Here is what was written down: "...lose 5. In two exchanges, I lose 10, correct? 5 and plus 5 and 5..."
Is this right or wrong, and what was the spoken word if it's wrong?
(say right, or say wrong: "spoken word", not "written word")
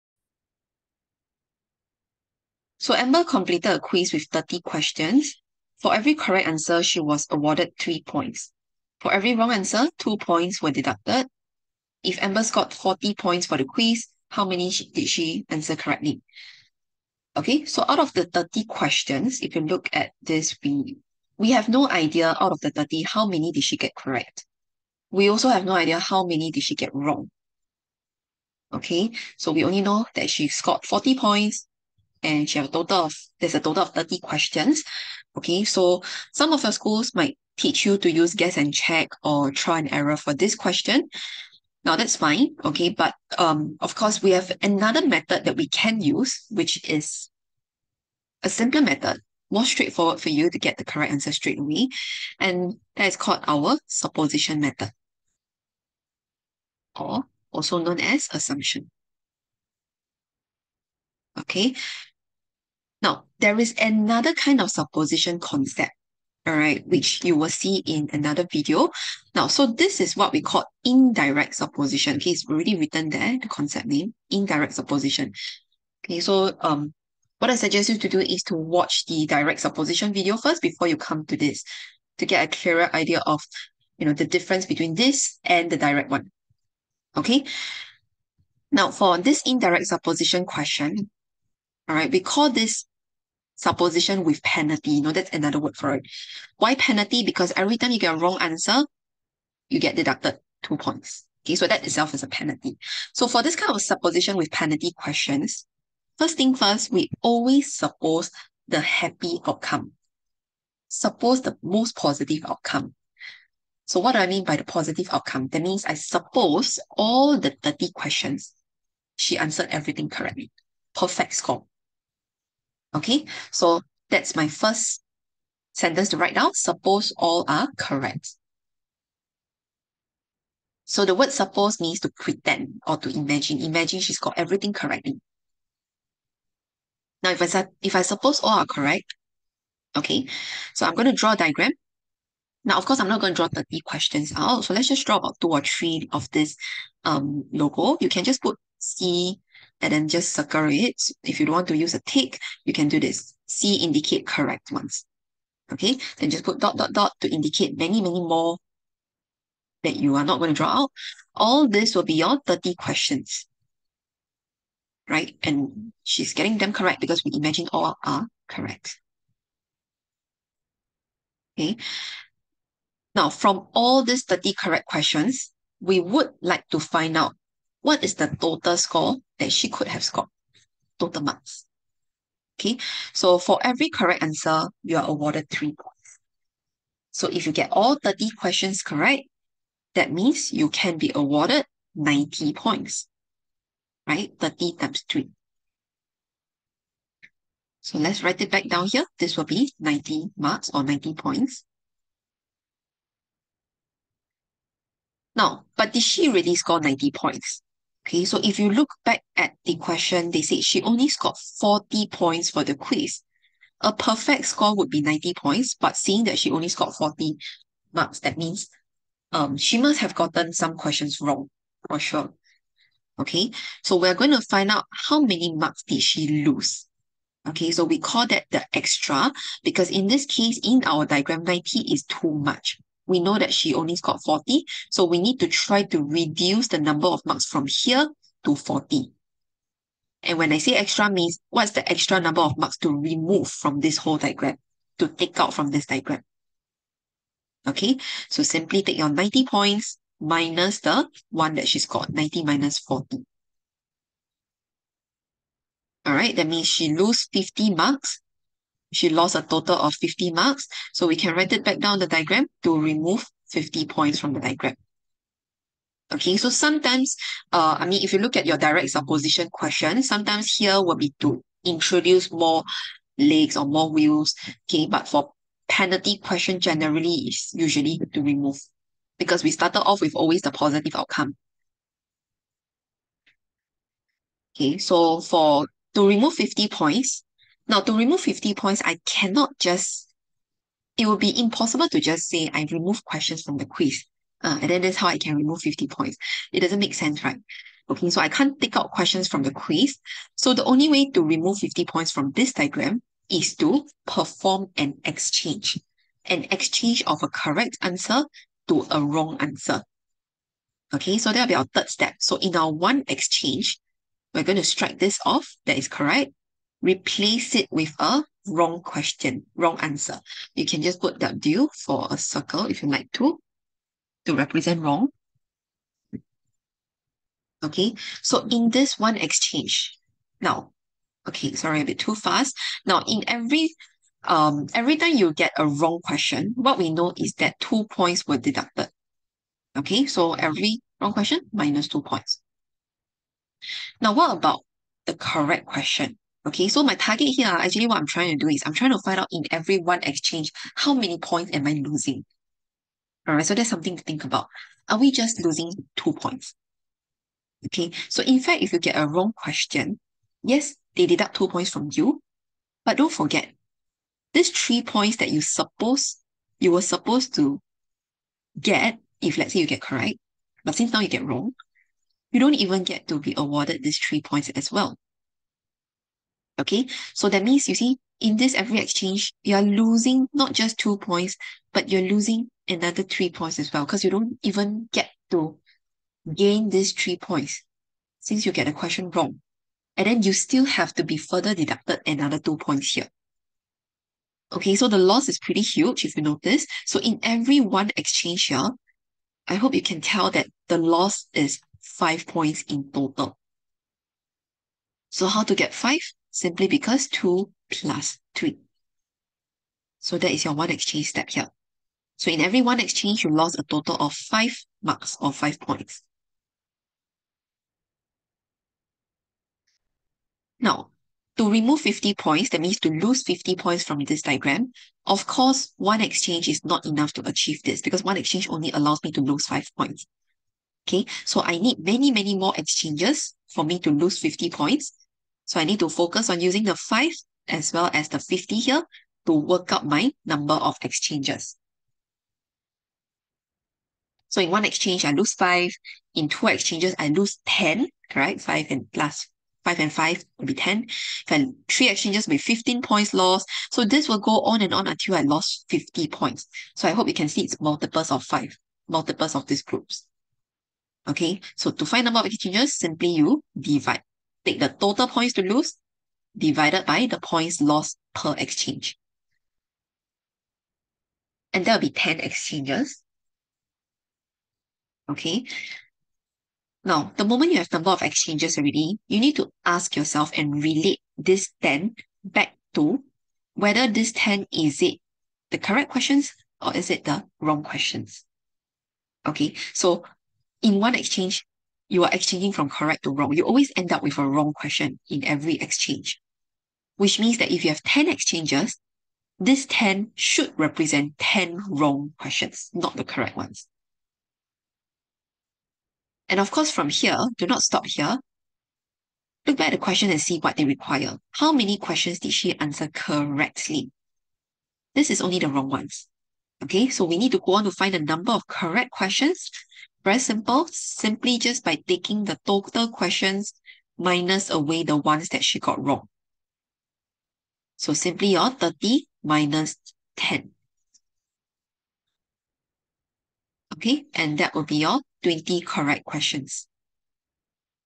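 right.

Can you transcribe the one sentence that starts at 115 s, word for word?
That means I suppose all the 30 questions, she answered everything correctly.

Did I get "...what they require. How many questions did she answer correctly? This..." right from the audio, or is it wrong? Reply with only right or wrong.
right.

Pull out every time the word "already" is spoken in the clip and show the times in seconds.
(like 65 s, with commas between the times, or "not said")
72 s, 478 s.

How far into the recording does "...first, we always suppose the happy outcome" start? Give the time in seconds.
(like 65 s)
106 s.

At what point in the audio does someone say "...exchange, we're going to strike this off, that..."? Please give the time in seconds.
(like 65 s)
313 s.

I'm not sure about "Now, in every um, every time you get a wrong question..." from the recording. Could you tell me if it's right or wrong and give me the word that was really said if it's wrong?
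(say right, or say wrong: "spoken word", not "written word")
right.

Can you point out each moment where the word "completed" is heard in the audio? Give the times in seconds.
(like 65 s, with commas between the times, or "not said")
3 s.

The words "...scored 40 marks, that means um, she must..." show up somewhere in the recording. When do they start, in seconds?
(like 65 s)
216 s.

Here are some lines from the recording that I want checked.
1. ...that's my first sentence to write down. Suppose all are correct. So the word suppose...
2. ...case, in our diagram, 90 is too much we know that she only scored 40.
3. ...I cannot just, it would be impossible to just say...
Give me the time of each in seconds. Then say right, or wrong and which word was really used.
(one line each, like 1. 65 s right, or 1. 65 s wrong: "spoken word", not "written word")
1. 124 s right
2. 230 s right
3. 288 s right.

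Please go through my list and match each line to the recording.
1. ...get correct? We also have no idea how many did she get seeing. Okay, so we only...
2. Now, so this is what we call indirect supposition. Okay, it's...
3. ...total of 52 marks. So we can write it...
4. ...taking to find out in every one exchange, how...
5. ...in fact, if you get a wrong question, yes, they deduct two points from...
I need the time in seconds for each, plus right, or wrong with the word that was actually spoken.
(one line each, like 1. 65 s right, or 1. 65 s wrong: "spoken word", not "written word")
1. 23 s wrong: "wrong", not "seeing"
2. 69 s right
3. 259 s wrong: "50", not "52"
4. 348 s wrong: "trying", not "taking"
5. 358 s right.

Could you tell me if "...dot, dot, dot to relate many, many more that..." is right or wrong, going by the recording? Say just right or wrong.
wrong.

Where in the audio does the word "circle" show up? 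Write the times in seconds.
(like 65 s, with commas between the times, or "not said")
150 s, 322 s.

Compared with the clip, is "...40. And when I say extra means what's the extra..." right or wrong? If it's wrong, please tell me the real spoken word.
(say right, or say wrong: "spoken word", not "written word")
right.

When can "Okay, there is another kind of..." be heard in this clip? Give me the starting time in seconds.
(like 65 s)
61 s.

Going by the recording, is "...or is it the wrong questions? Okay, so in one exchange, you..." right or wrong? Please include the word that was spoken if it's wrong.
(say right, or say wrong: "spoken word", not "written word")
right.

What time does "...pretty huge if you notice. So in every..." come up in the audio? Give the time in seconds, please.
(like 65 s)
395 s.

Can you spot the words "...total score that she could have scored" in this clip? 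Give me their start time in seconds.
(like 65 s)
178 s.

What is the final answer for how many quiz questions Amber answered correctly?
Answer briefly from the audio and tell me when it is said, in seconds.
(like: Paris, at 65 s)
20, at 535 s.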